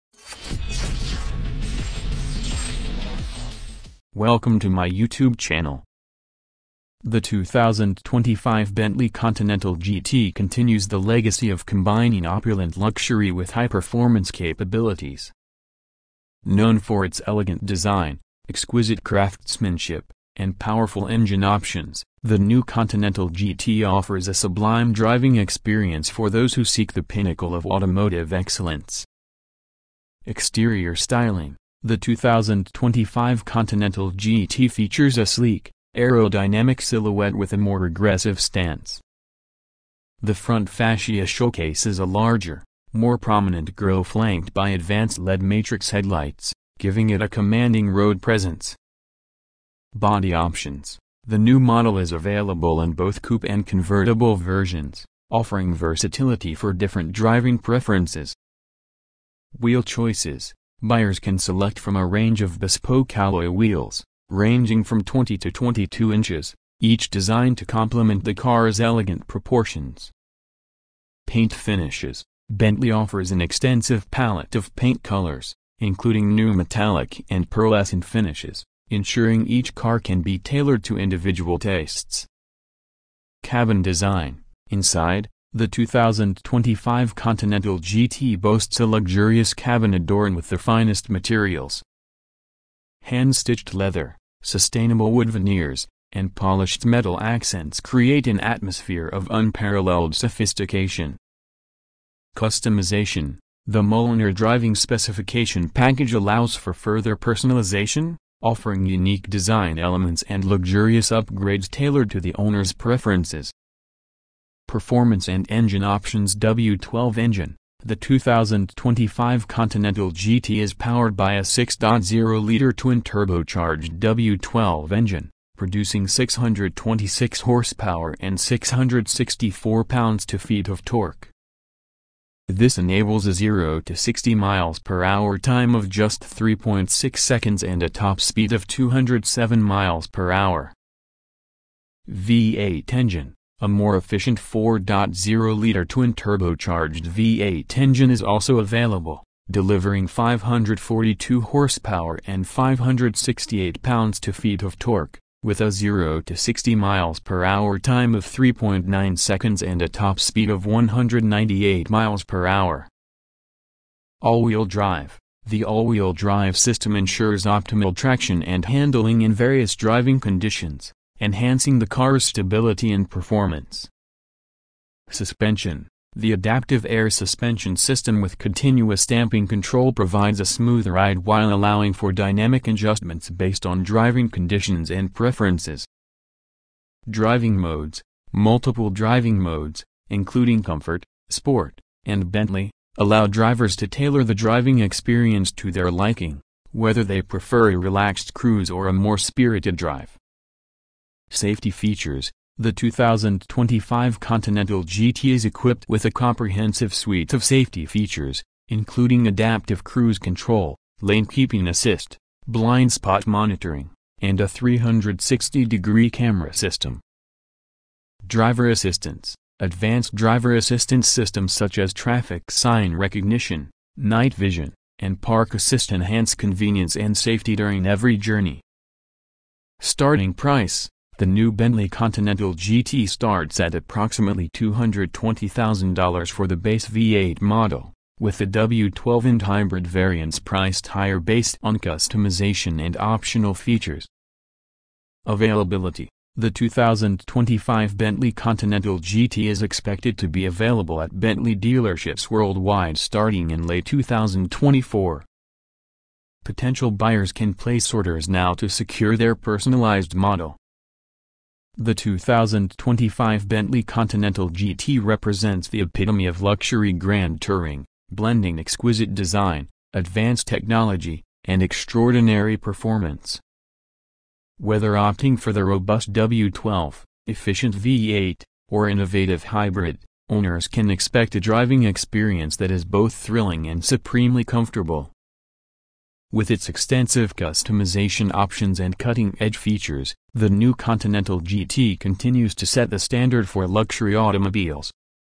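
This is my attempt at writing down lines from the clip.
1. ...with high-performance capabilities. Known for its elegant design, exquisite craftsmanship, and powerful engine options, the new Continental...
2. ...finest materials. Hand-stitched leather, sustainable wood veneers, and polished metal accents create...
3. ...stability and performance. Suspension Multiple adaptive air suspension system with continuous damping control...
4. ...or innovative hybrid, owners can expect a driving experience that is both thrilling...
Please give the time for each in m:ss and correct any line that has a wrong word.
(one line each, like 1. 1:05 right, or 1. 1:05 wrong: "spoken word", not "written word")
1. 0:13 right
2. 1:30 right
3. 2:52 wrong: "The", not "Multiple"
4. 4:38 right.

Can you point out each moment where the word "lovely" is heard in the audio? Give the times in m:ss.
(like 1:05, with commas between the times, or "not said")
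not said.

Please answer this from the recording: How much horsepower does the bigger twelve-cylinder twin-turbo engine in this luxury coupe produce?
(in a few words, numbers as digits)
626 horsepower.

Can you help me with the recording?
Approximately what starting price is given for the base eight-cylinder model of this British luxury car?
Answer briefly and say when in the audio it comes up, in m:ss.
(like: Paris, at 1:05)
$220,000, at 3:54.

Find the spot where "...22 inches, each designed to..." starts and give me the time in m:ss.
1:05.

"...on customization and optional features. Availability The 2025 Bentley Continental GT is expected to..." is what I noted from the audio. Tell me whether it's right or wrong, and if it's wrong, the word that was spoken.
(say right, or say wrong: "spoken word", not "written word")
right.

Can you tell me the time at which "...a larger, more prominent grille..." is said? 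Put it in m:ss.
0:41.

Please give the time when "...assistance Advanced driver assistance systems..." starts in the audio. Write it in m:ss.
3:38.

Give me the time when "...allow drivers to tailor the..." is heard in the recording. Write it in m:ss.
3:12.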